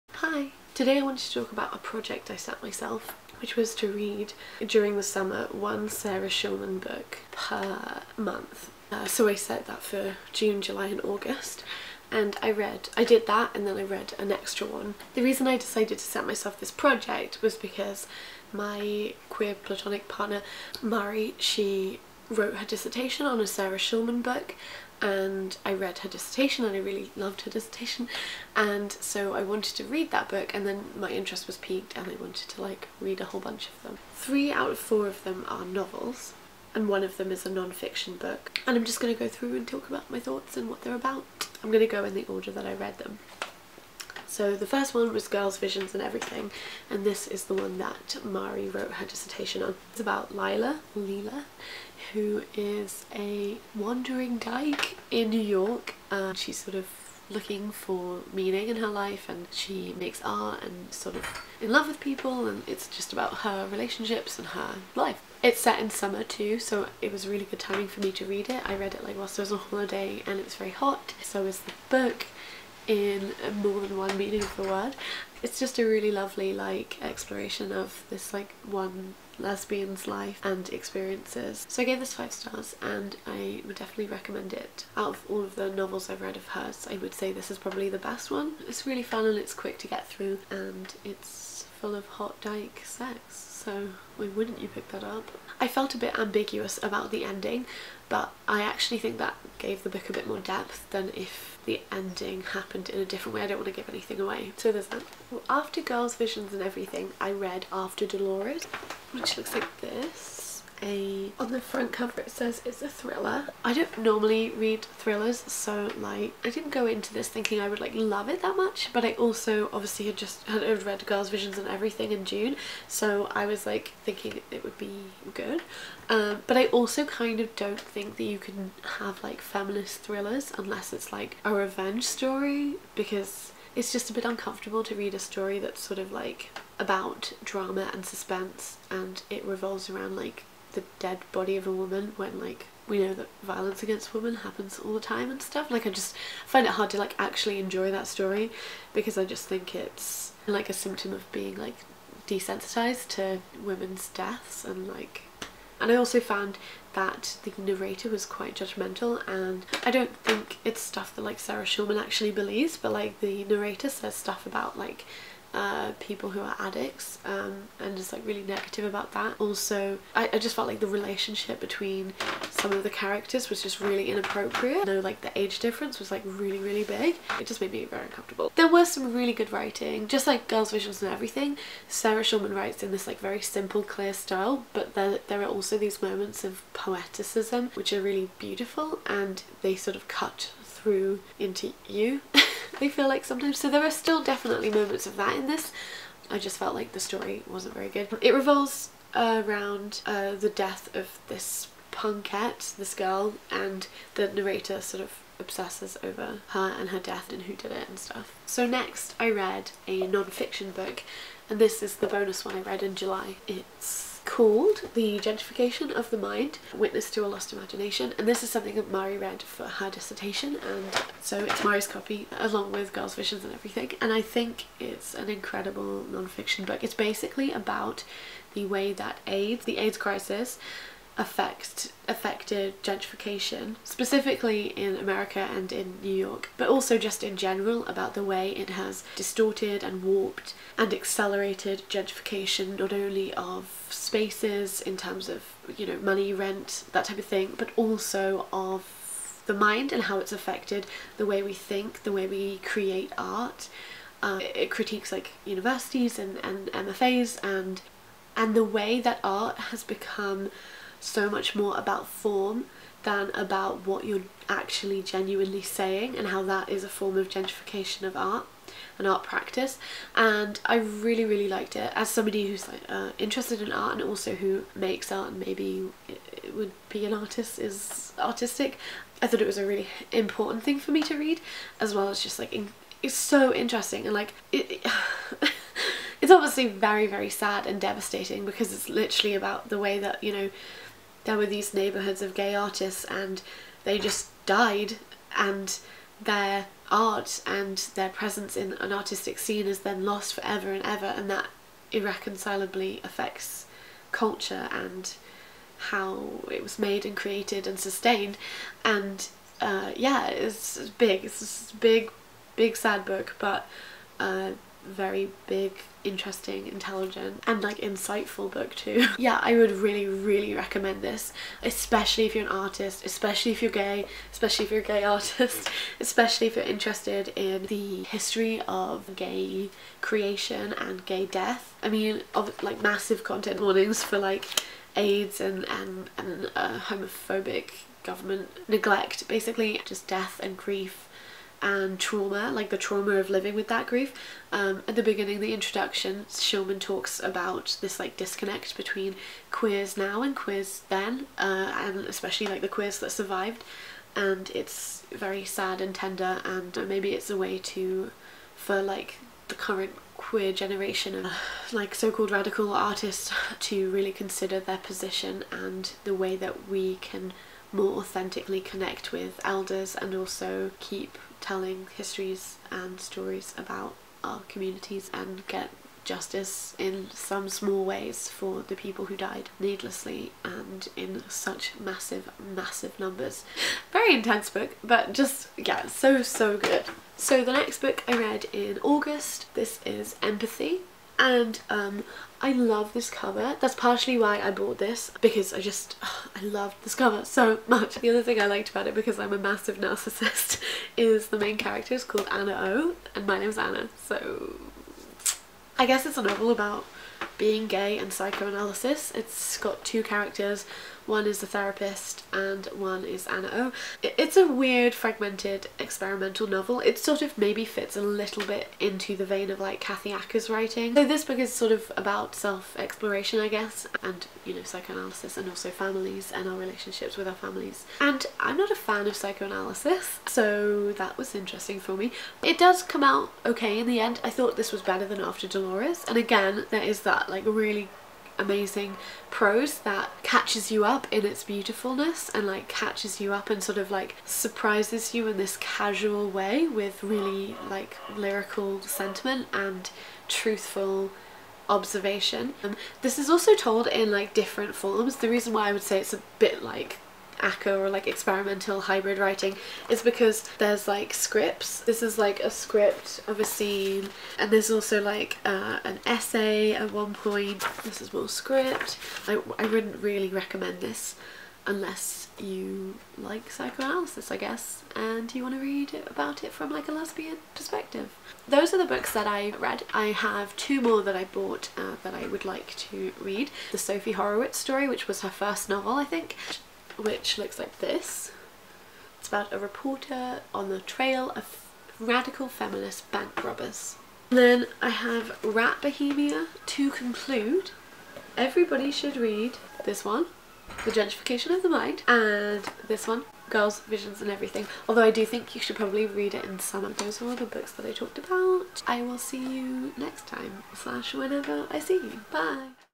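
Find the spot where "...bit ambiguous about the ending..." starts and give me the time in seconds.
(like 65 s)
95 s.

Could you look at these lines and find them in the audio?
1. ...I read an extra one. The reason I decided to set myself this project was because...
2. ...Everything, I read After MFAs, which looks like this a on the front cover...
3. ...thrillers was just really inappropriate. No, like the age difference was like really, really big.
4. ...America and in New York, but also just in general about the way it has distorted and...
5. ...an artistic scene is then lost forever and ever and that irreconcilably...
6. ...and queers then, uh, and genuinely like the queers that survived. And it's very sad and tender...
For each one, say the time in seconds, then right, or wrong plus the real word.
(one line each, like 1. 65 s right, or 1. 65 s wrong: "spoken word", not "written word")
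1. 13 s right
2. 106 s wrong: "Delores", not "MFAs"
3. 172 s wrong: "characters", not "thrillers"
4. 234 s right
5. 298 s right
6. 350 s wrong: "especially", not "genuinely".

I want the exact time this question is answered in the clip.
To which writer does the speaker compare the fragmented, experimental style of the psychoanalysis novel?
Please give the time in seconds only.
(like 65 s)
419 s.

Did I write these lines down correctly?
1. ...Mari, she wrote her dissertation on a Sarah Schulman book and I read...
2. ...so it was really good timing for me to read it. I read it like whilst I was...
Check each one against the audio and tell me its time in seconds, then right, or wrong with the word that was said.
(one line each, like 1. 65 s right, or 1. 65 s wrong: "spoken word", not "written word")
1. 20 s right
2. 66 s right.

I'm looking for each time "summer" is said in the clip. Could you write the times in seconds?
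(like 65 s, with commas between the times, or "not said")
5 s, 65 s.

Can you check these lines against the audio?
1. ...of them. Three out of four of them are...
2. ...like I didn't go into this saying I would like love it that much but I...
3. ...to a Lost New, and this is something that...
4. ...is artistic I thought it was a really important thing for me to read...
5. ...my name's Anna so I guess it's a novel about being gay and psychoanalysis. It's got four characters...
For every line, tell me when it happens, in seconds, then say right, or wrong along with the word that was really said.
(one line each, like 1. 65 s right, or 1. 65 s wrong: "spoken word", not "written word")
1. 33 s right
2. 115 s wrong: "thinking", not "saying"
3. 217 s wrong: "Imagination", not "New"
4. 277 s right
5. 403 s wrong: "two", not "four".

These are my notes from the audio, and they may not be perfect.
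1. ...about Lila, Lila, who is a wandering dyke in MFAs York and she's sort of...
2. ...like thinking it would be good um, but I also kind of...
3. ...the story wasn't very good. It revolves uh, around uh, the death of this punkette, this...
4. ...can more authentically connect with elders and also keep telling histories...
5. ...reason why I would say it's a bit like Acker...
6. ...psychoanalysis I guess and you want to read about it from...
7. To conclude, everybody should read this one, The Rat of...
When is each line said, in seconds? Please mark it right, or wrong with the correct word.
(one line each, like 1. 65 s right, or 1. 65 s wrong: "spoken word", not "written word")
1. 49 s wrong: "New", not "MFAs"
2. 123 s right
3. 196 s right
4. 366 s right
5. 455 s right
6. 473 s right
7. 496 s wrong: "Gentrification", not "Rat".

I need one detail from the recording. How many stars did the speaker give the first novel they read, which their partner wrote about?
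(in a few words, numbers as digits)
5.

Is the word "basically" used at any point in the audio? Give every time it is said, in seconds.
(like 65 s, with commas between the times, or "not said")
226 s, 339 s.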